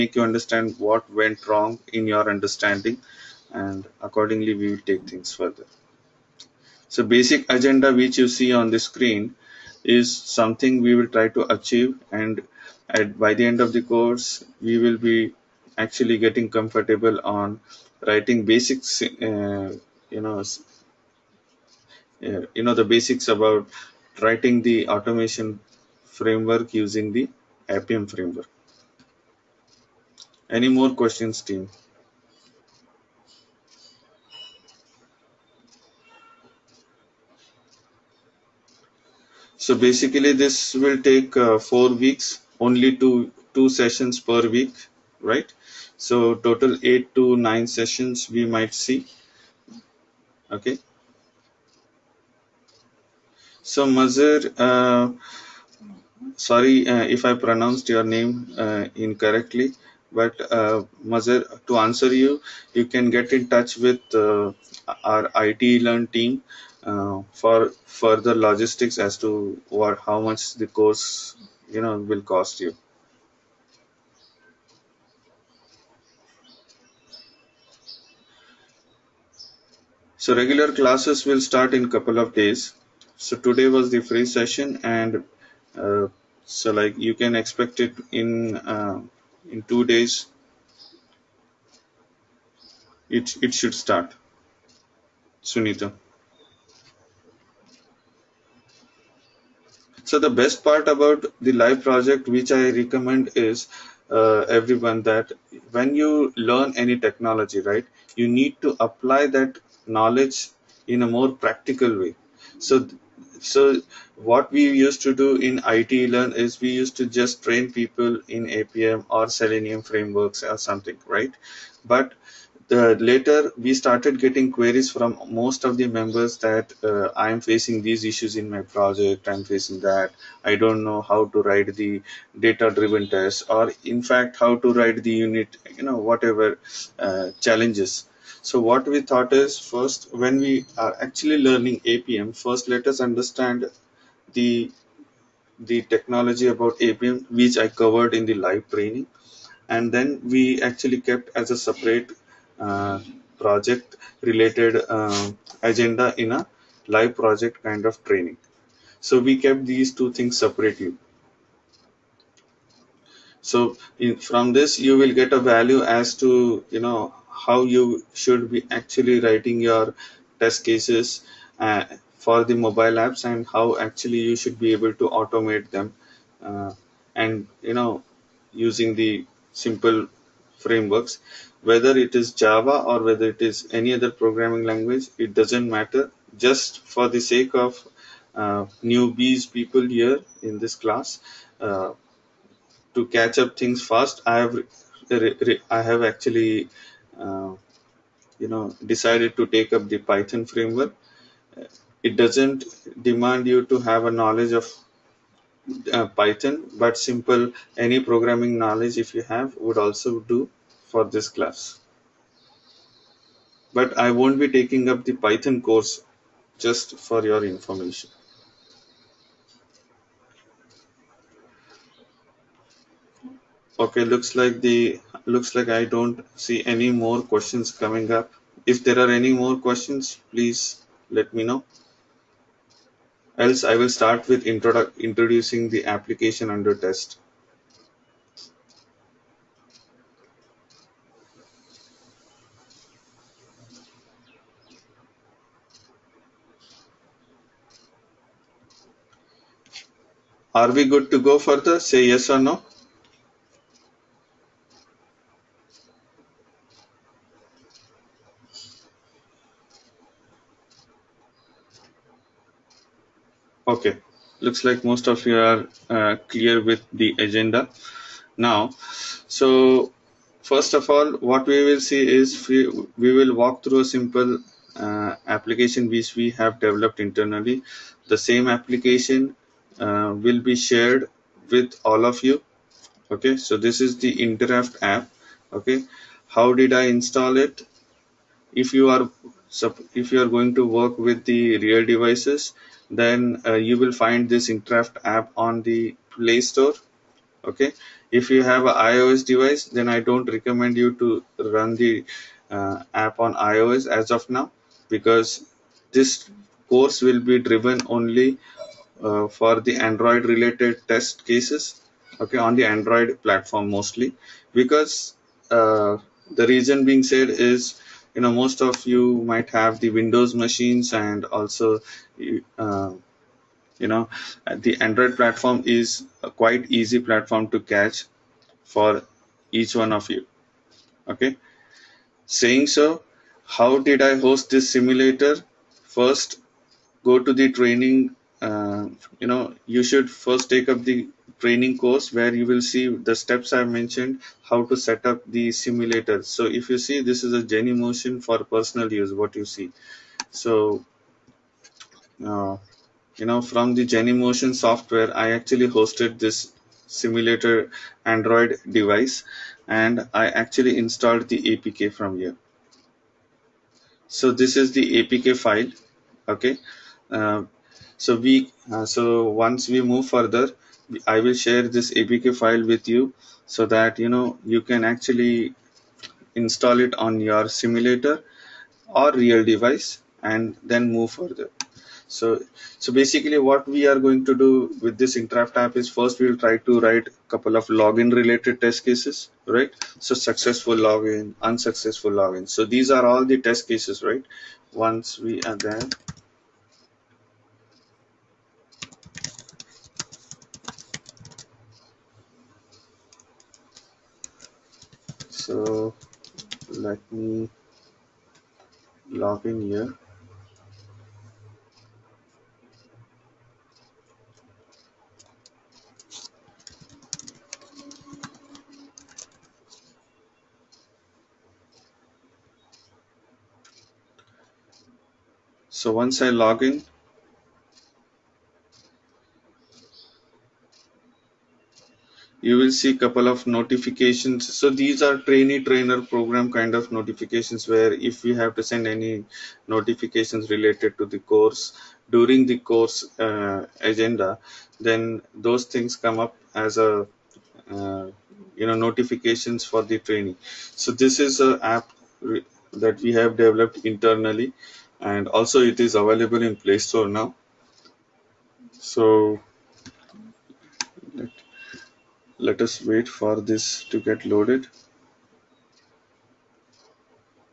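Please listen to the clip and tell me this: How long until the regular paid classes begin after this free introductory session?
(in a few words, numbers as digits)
2 days.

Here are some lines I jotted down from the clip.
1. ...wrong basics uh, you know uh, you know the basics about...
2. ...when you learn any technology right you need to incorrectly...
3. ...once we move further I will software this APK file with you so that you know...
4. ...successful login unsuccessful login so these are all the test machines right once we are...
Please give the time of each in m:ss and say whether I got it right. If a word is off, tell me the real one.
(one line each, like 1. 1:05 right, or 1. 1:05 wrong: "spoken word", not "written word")
1. 0:18 wrong: "writing", not "wrong"
2. 1:45 wrong: "apply", not "incorrectly"
3. 6:09 wrong: "share", not "software"
4. 6:30 wrong: "cases", not "machines".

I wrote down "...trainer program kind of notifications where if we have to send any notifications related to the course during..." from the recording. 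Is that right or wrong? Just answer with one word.
right.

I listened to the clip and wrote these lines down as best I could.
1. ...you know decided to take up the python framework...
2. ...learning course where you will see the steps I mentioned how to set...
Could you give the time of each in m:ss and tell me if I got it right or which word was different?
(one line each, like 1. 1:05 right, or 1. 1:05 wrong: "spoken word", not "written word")
1. 3:18 right
2. 5:41 wrong: "training", not "learning".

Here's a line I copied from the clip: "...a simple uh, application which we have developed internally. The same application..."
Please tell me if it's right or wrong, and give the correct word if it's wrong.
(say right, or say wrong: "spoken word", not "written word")
right.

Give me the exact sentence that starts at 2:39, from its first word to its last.
So we kept these two things separately.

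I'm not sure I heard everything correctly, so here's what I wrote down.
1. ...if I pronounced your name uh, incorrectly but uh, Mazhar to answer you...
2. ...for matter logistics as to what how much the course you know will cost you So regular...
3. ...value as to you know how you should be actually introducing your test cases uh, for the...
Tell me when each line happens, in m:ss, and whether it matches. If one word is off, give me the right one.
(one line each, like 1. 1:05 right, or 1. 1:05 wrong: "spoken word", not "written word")
1. 0:57 right
2. 1:07 wrong: "further", not "matter"
3. 2:45 wrong: "writing", not "introducing".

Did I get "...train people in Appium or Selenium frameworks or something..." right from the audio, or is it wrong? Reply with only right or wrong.
right.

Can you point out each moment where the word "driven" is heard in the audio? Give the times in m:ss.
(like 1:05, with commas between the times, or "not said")
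2:12, 5:07.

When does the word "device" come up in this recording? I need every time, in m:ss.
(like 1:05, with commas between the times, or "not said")
4:51, 4:59, 5:58, 6:19.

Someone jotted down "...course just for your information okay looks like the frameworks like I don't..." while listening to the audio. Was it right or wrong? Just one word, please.
wrong.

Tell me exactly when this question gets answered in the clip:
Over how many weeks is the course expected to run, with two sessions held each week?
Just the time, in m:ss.
0:41.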